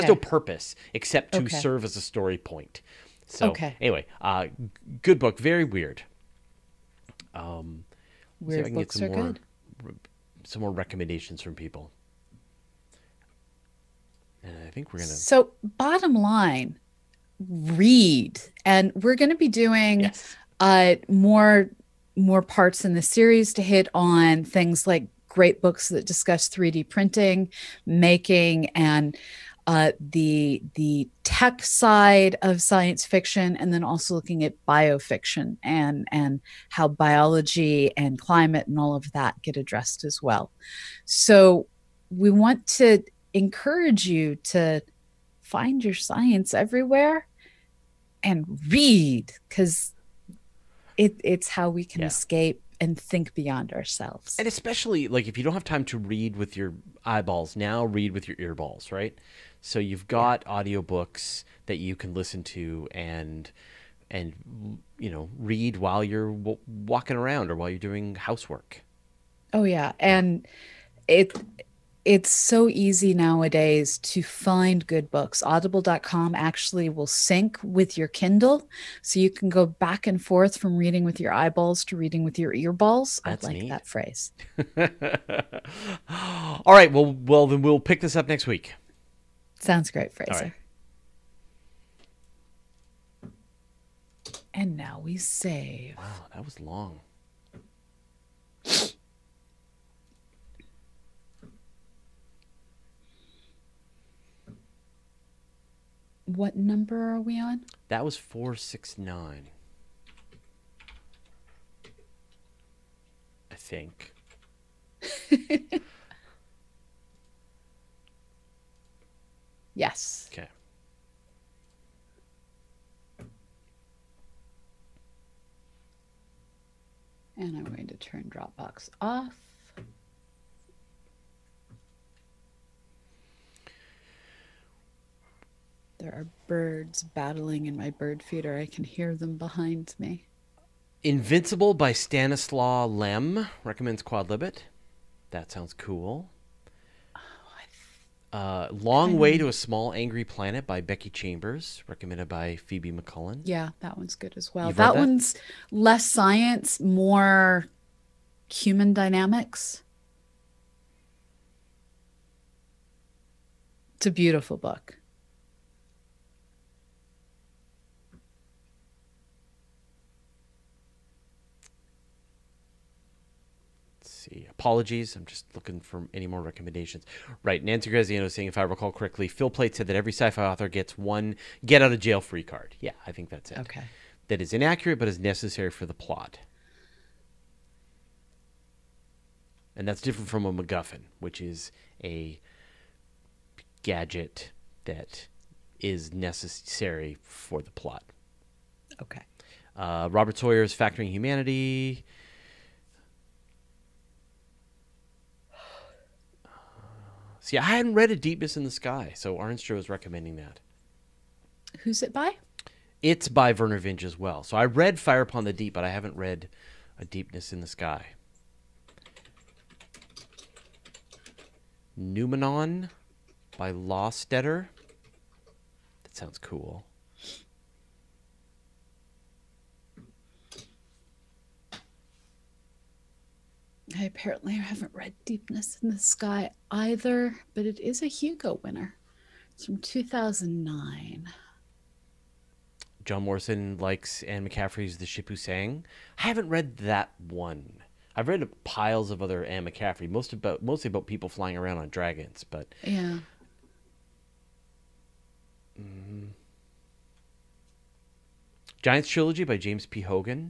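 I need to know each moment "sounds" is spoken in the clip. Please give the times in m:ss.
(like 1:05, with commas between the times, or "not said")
1:29, 2:25, 3:46.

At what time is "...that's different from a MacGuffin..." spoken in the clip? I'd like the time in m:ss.
3:09.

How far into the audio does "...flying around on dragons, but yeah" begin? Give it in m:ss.
4:11.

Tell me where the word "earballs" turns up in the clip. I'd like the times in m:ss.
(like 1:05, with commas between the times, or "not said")
0:58, 1:22.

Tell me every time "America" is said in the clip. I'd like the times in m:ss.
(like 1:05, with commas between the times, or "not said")
not said.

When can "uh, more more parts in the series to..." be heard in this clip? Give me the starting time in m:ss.
0:20.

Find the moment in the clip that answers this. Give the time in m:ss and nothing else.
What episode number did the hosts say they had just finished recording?
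1:48.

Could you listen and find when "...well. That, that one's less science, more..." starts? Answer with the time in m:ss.
2:34.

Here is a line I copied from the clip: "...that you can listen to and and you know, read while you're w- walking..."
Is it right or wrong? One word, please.
right.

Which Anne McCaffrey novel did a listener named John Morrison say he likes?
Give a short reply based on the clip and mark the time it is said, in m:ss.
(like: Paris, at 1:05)
The Ship Who Sang, at 4:04.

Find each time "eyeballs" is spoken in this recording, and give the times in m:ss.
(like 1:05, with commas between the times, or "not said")
0:57, 1:21.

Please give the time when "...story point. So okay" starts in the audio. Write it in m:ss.
0:02.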